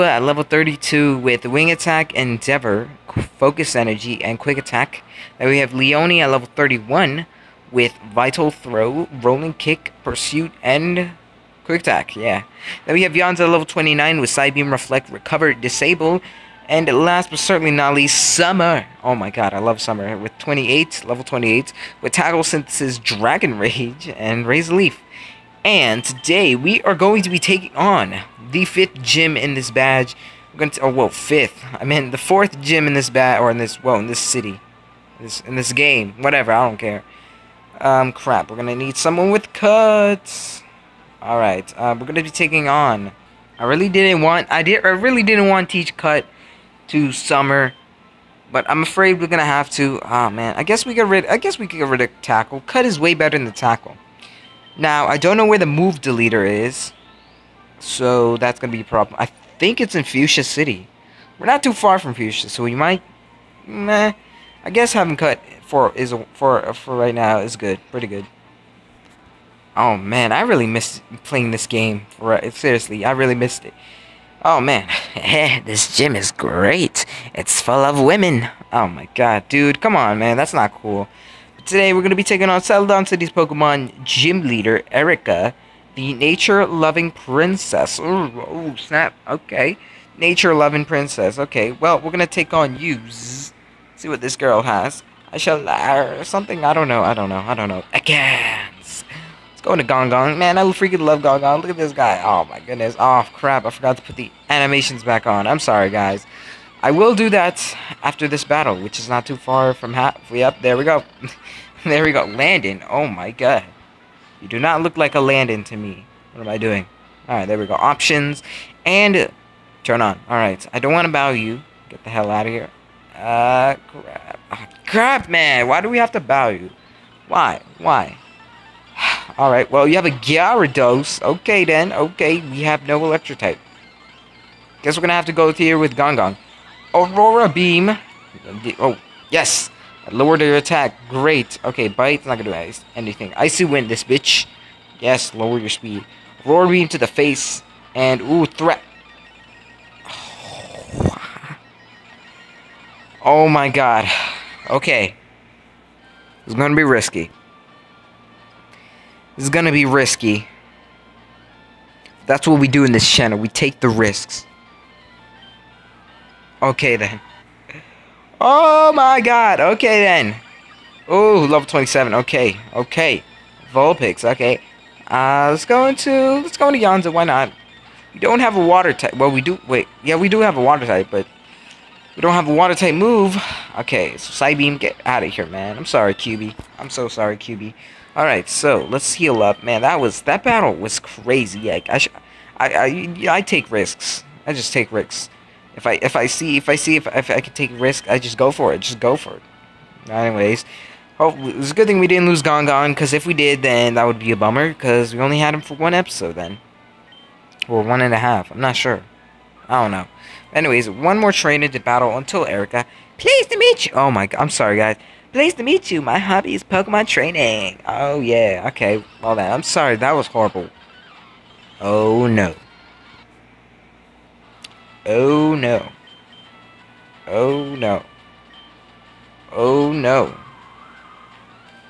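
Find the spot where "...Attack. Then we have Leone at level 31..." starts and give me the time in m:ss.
0:04.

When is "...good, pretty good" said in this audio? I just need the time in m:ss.
1:07.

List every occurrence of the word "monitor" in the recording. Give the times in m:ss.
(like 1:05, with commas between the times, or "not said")
not said.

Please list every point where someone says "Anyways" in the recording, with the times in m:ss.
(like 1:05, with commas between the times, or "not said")
3:20, 3:30.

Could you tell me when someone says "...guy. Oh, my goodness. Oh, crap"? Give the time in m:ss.
1:41.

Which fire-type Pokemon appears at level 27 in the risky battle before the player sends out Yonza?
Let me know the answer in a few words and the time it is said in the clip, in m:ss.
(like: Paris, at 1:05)
Vulpix, at 2:53.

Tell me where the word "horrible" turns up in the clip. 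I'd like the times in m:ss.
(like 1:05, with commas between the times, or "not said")
3:40.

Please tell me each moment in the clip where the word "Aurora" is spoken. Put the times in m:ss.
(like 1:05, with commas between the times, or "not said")
2:16, 2:26.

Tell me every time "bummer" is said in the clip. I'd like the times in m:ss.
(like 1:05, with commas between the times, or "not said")
3:24.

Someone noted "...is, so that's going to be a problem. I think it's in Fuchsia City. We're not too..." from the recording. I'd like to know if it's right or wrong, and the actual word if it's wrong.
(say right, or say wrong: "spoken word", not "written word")
right.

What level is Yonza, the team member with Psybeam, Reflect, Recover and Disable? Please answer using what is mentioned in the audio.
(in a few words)
29.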